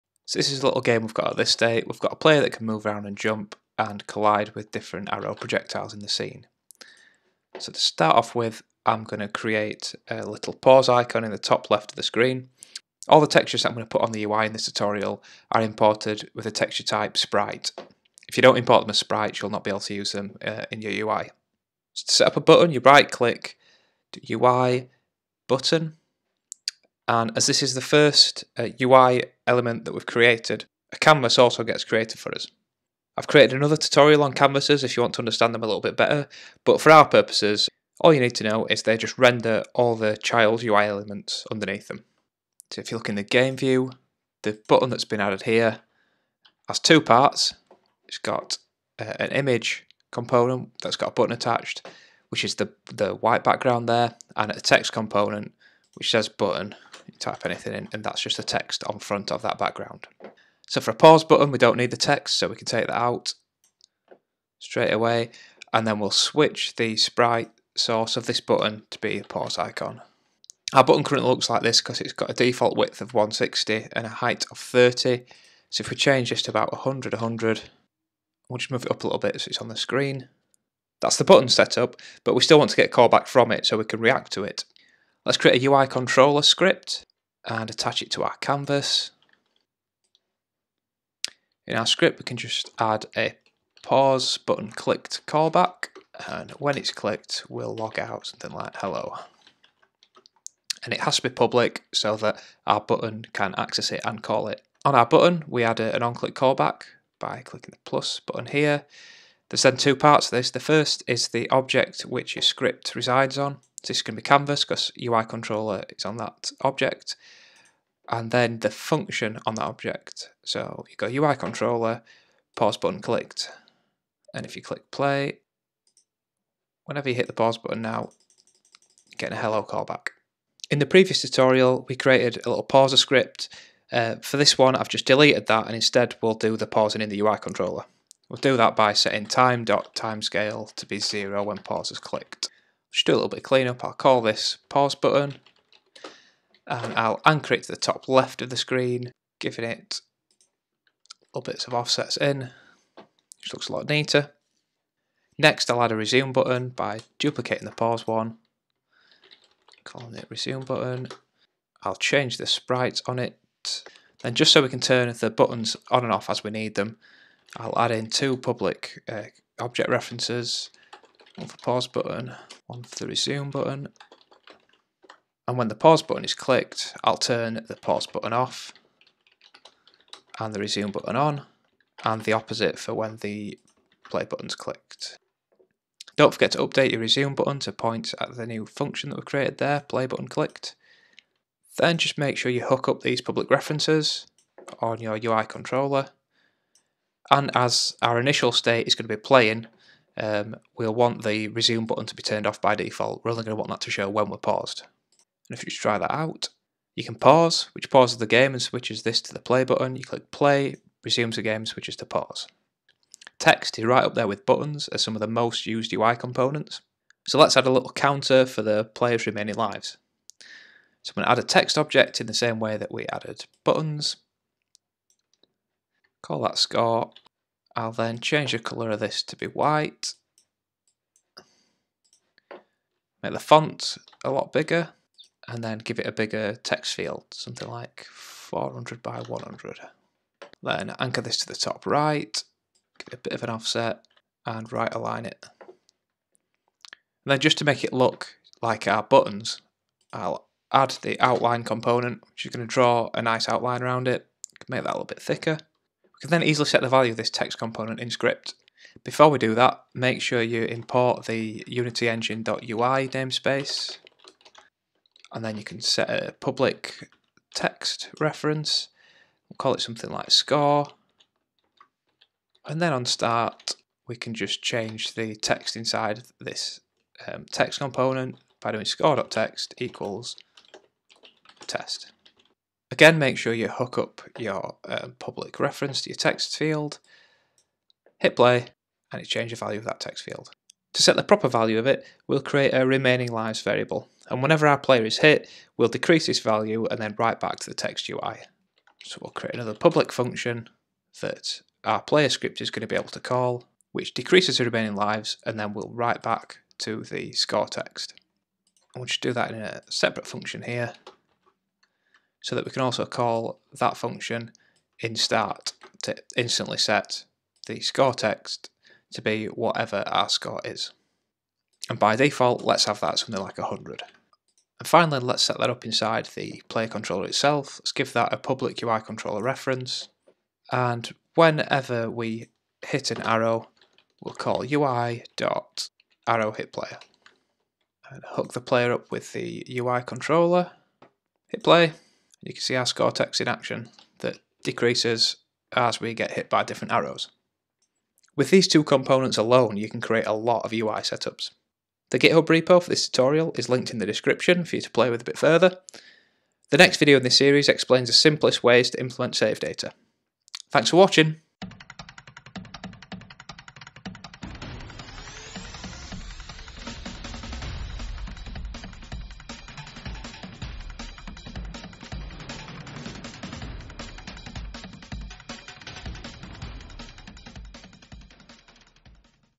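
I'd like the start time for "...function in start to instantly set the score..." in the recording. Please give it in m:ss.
5:13.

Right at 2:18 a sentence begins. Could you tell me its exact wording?
We'll do that by setting time.timescale to be zero when pause is clicked just do a little bit of cleanup.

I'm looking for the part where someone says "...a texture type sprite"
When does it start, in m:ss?
0:16.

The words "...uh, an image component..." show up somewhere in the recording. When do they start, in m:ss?
0:48.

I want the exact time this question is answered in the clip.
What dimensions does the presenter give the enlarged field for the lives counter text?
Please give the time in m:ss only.
3:58.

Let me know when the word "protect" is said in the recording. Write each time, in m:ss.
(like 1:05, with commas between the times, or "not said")
not said.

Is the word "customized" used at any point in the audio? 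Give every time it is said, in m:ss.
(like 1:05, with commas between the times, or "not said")
not said.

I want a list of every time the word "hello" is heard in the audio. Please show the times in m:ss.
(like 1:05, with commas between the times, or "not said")
1:38, 2:09.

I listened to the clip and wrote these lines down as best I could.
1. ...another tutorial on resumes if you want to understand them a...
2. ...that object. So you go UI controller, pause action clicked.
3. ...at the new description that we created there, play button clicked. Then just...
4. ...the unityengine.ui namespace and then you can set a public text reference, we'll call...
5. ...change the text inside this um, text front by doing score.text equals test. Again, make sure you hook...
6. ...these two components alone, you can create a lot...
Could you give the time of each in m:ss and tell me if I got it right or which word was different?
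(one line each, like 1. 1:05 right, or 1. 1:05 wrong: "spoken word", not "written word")
1. 0:33 wrong: "canvases", not "resumes"
2. 1:59 wrong: "button", not "action"
3. 3:08 wrong: "function", not "description"
4. 4:21 right
5. 4:34 wrong: "component", not "front"
6. 5:48 right.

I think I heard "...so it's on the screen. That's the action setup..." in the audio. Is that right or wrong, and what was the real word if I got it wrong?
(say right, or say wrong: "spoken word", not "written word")
wrong: "button", not "action".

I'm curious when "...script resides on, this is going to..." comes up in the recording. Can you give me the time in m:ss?
1:52.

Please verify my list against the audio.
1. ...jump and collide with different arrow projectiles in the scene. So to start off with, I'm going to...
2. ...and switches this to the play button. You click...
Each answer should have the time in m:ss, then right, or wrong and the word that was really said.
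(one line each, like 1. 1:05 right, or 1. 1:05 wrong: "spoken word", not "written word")
1. 0:03 right
2. 3:28 right.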